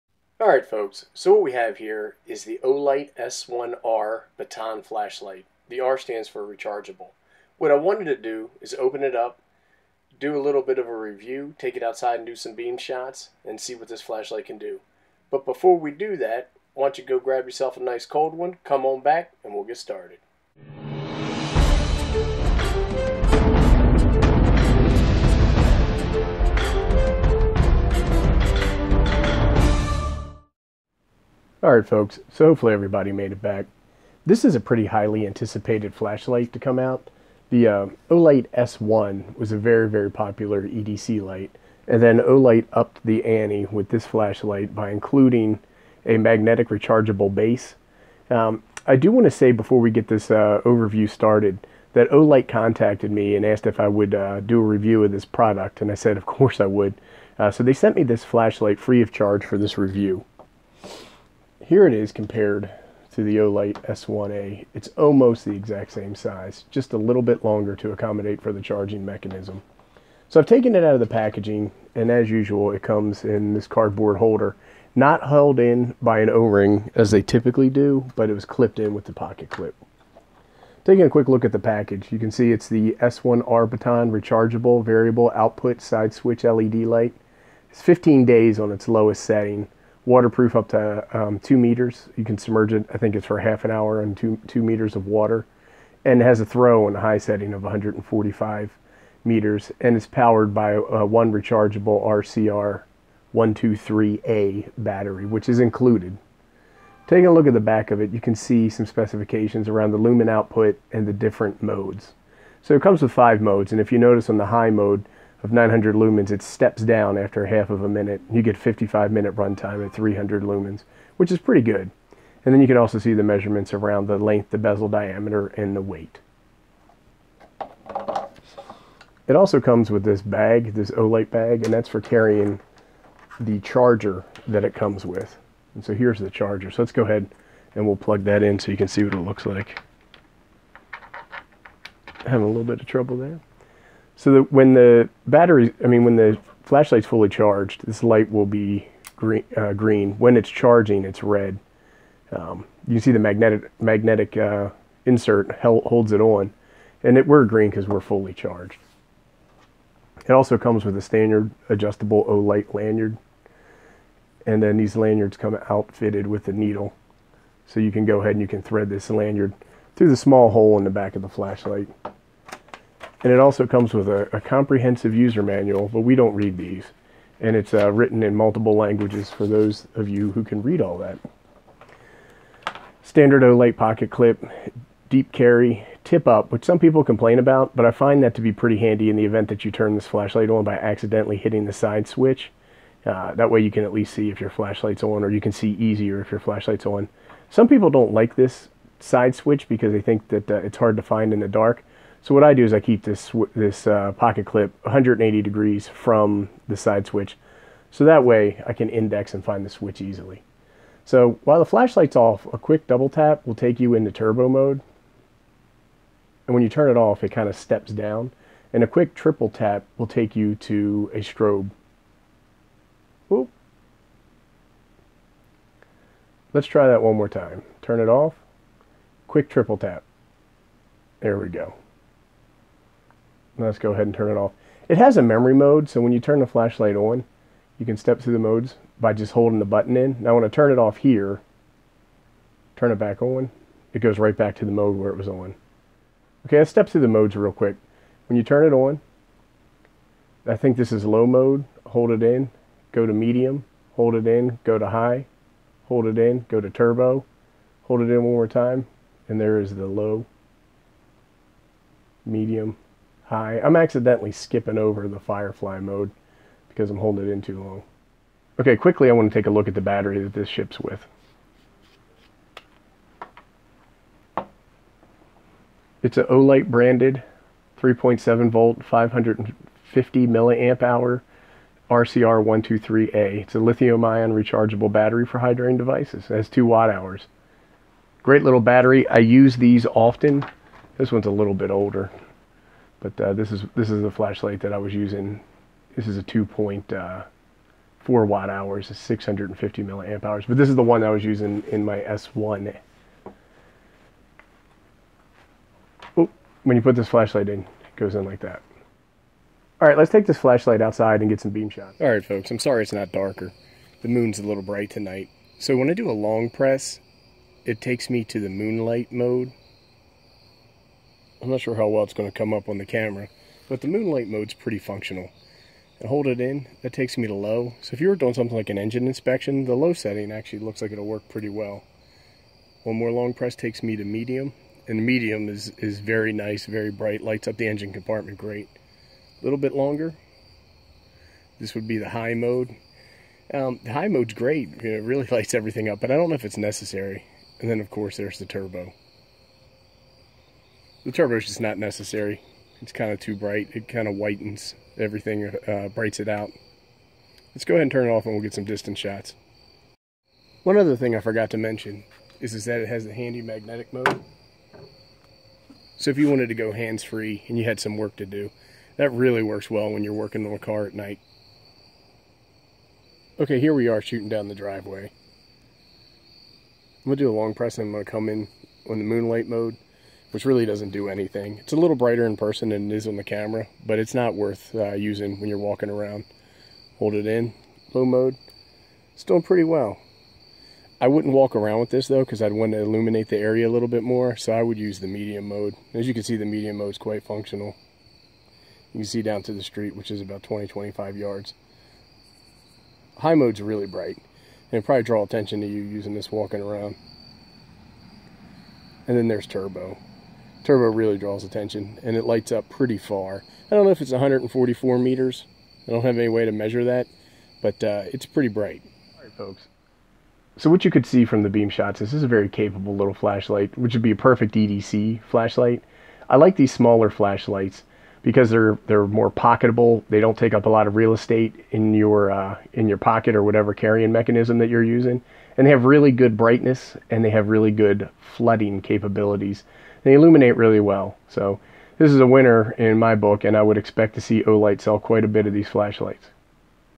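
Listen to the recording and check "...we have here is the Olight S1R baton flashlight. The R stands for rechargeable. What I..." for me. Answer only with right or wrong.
right.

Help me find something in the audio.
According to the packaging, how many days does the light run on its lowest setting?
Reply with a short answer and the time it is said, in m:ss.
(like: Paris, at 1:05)
15 days, at 1:27.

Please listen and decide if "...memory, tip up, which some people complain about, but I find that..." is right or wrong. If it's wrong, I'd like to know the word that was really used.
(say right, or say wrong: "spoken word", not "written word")
wrong: "carry", not "memory".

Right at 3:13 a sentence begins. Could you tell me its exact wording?
Uh, that way you can at least see if your flashlight's on, or you can see easier if your flashlight's on.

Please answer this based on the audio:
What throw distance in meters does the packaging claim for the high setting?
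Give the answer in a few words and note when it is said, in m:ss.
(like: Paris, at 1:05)
145 meters, at 1:37.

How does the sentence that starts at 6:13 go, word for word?
Okay, here we are shooting down the driveway.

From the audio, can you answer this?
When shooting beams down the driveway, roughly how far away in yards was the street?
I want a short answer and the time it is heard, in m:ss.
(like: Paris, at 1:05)
20 to 25 yards, at 6:40.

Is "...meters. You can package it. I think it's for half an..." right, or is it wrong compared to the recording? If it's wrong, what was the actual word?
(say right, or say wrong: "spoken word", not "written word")
wrong: "submerge", not "package".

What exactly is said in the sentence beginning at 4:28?
Okay, quickly I want to take a look at the battery that this ships with.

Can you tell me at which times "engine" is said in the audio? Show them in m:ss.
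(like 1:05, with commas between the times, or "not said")
5:28, 5:37.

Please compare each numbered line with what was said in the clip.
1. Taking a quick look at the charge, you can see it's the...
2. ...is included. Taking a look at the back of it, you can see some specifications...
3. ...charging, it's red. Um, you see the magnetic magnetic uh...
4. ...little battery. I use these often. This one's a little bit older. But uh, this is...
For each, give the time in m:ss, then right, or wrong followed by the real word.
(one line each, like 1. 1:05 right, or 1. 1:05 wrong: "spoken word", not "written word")
1. 1:20 wrong: "package", not "charge"
2. 1:45 right
3. 2:30 right
4. 4:48 right.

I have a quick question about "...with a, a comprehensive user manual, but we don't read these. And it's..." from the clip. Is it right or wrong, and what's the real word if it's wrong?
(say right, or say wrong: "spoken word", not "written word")
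right.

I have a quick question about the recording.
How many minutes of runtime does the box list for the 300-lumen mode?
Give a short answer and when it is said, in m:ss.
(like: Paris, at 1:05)
55 minutes, at 1:58.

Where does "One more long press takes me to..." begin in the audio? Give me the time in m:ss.
5:32.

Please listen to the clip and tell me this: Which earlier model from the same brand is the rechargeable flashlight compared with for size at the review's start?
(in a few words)
Olight S1A.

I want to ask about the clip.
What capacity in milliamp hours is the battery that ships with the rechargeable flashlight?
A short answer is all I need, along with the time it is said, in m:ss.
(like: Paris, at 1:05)
550 milliamp hours, at 4:38.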